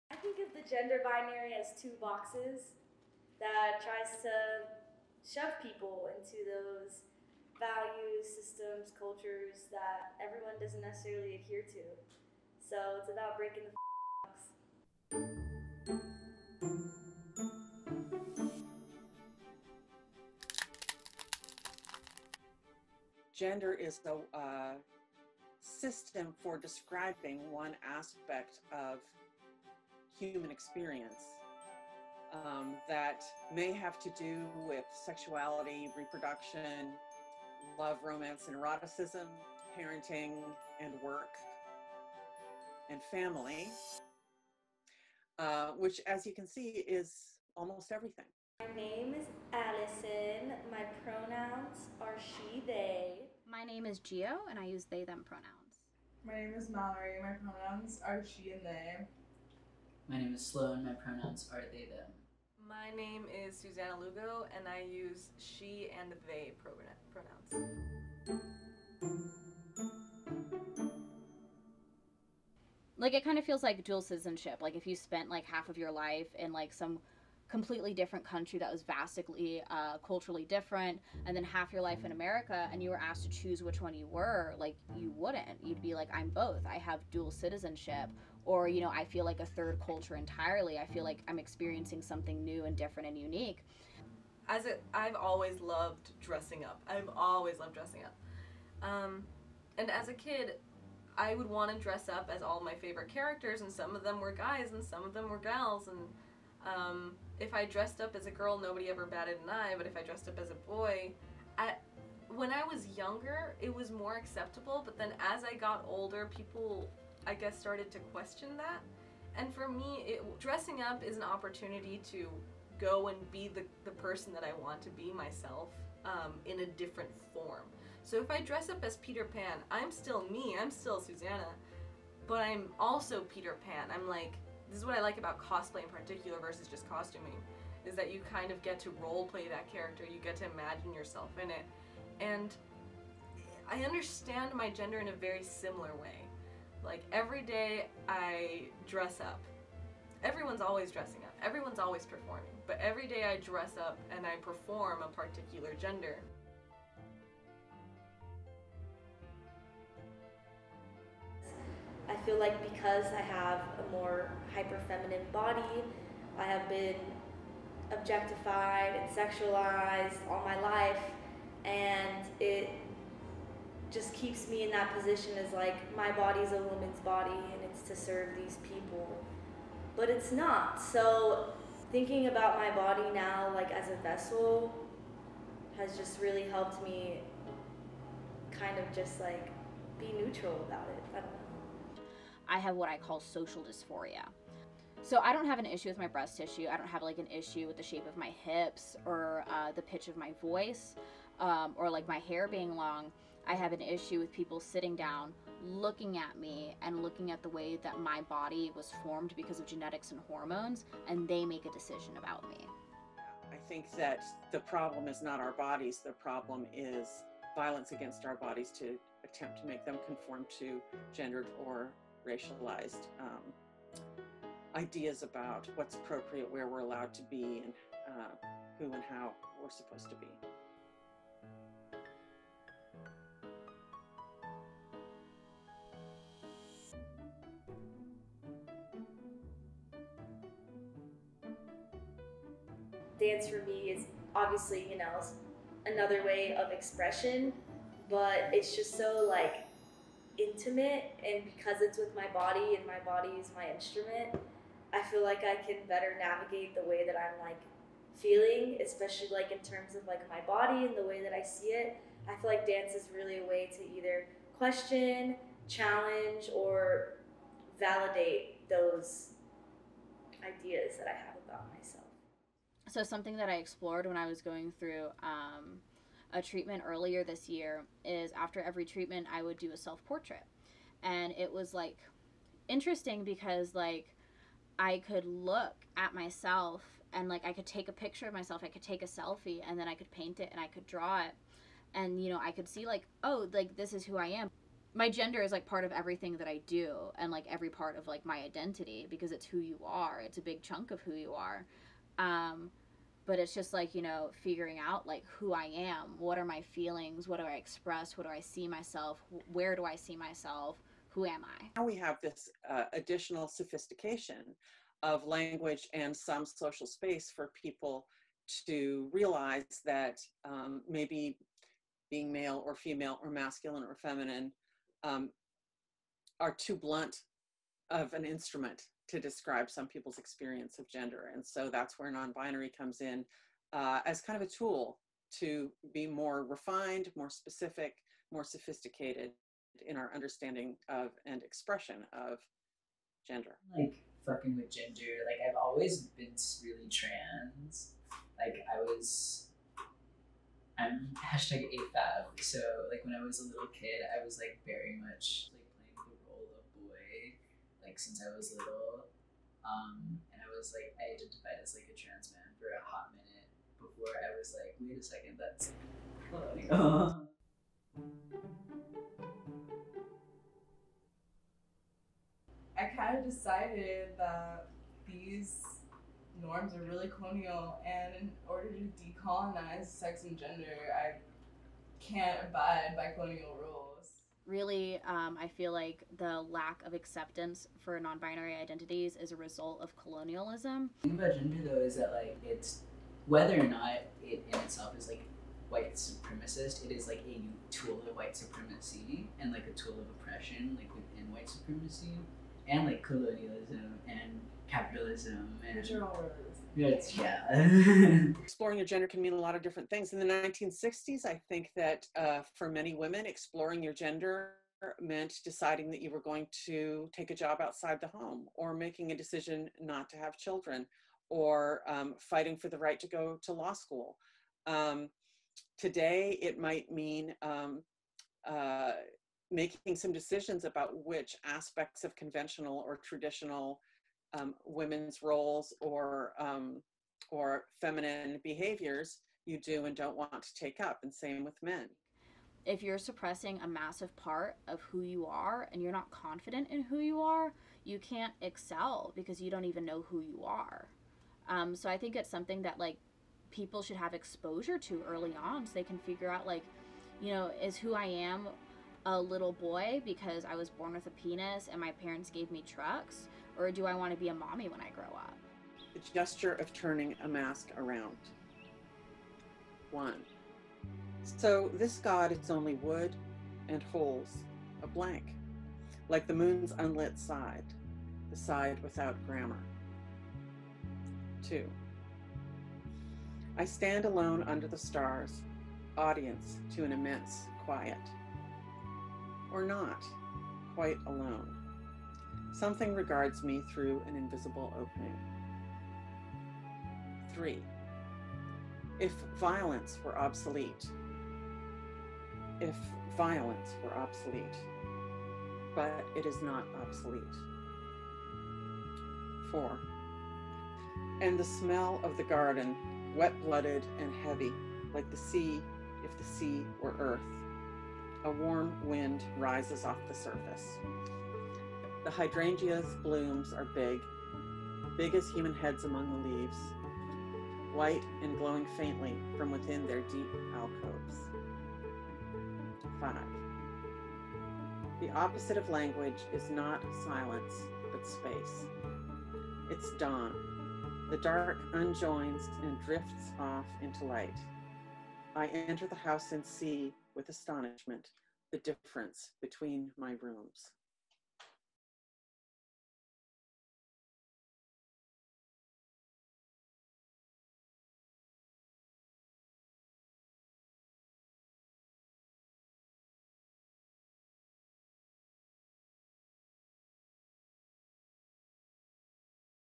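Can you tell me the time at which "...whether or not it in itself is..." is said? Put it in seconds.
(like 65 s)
393 s.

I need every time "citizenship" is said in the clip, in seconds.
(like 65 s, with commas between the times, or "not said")
74 s, 87 s.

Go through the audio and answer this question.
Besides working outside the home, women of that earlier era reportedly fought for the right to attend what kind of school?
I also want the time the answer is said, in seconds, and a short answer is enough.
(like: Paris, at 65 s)
Law school, at 423 s.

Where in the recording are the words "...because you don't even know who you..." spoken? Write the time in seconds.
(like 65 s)
449 s.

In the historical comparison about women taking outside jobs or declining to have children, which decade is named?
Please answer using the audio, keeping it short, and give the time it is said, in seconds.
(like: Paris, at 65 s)
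1960s, at 410 s.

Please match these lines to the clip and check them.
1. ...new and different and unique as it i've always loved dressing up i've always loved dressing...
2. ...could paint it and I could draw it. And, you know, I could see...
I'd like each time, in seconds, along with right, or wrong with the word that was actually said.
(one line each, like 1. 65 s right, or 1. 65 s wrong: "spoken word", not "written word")
1. 92 s right
2. 289 s right.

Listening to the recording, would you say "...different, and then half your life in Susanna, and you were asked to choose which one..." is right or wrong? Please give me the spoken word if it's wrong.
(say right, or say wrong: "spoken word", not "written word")
wrong: "America", not "Susanna".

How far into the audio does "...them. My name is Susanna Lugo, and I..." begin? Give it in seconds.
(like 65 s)
61 s.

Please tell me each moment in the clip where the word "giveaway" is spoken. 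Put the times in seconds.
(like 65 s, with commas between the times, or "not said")
not said.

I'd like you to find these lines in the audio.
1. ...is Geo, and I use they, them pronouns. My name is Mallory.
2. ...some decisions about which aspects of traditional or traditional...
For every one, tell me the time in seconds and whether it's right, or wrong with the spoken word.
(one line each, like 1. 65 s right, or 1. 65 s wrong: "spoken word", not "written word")
1. 53 s right
2. 429 s wrong: "conventional", not "traditional".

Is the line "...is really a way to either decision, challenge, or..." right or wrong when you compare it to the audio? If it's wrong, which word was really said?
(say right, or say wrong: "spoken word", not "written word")
wrong: "question", not "decision".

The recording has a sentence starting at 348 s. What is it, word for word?
Like I was, I'm hashtag AFAB.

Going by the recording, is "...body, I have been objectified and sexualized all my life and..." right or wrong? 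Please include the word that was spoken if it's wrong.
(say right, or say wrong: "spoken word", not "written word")
right.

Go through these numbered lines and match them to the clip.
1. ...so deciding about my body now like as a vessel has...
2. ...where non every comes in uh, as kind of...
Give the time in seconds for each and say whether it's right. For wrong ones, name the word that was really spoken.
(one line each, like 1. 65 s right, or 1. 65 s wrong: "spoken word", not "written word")
1. 180 s wrong: "thinking", not "deciding"
2. 331 s wrong: "binary", not "every".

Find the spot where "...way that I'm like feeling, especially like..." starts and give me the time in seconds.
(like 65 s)
256 s.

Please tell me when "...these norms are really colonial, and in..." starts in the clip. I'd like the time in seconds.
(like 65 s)
375 s.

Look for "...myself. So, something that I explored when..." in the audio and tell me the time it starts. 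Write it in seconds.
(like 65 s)
271 s.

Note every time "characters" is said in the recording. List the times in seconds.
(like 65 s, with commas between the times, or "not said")
103 s, 139 s.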